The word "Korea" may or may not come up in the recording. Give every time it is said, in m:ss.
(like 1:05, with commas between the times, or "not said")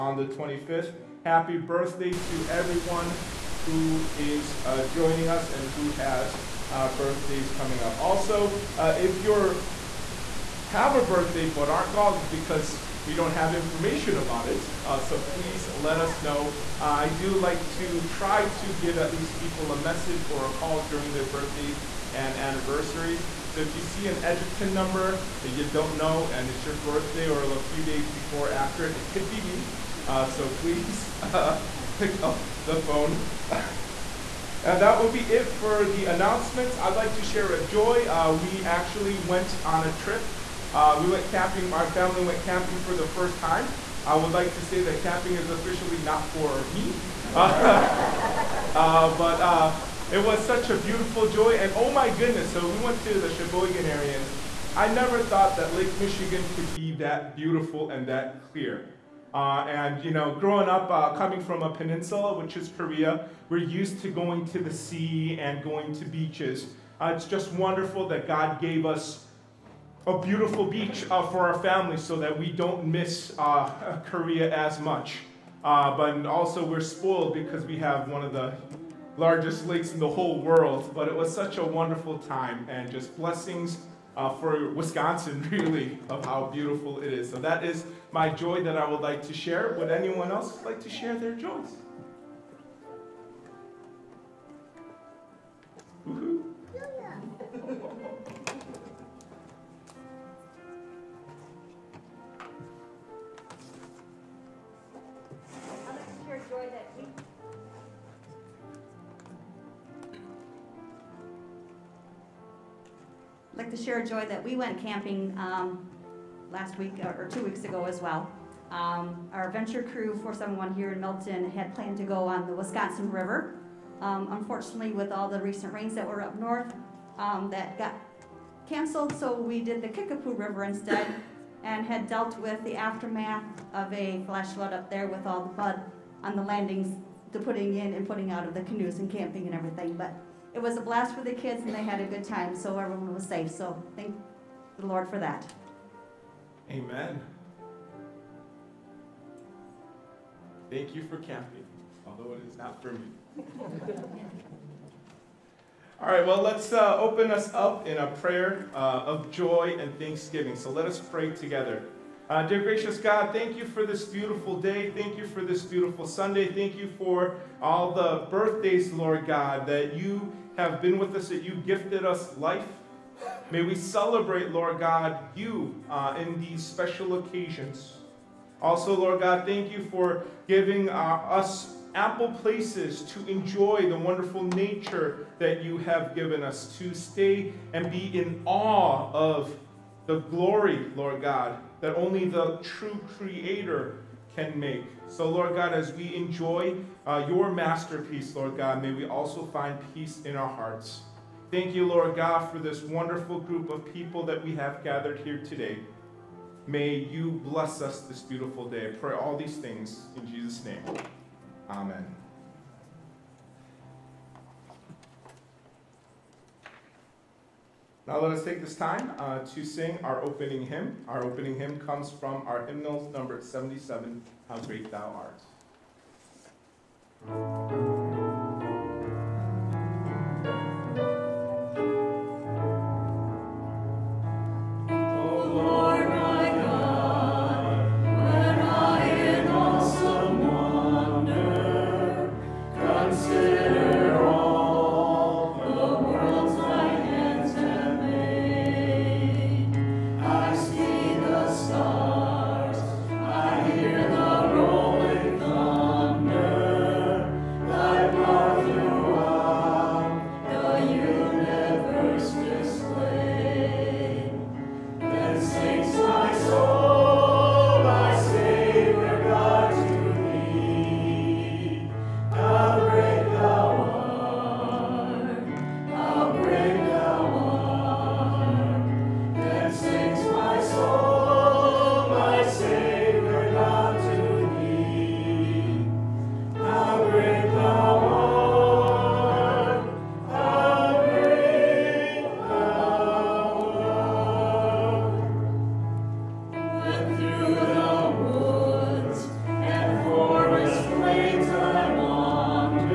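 1:02, 1:14.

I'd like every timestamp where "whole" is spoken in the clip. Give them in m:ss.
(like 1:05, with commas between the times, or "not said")
1:20.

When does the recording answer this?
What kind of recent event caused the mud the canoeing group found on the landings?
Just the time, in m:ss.
2:14.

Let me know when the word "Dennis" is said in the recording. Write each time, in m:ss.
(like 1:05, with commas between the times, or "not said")
not said.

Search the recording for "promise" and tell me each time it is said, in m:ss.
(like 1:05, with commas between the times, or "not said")
not said.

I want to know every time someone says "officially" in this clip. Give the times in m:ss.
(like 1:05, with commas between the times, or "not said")
0:45.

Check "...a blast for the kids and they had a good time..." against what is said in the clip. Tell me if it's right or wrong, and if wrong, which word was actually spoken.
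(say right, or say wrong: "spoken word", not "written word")
right.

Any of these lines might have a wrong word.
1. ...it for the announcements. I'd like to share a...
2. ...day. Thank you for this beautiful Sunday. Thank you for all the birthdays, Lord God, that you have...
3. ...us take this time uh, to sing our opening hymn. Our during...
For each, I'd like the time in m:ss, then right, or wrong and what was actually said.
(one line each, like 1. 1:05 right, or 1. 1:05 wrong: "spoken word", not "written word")
1. 0:35 right
2. 2:44 right
3. 3:38 wrong: "opening", not "during".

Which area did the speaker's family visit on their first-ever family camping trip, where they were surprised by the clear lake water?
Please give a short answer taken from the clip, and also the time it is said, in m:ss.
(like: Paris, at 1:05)
Sheboygan, at 0:53.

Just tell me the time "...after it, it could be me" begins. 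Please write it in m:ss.
0:28.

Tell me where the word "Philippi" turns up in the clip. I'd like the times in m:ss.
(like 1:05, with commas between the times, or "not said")
not said.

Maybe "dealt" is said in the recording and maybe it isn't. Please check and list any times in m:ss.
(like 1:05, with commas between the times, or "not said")
2:12.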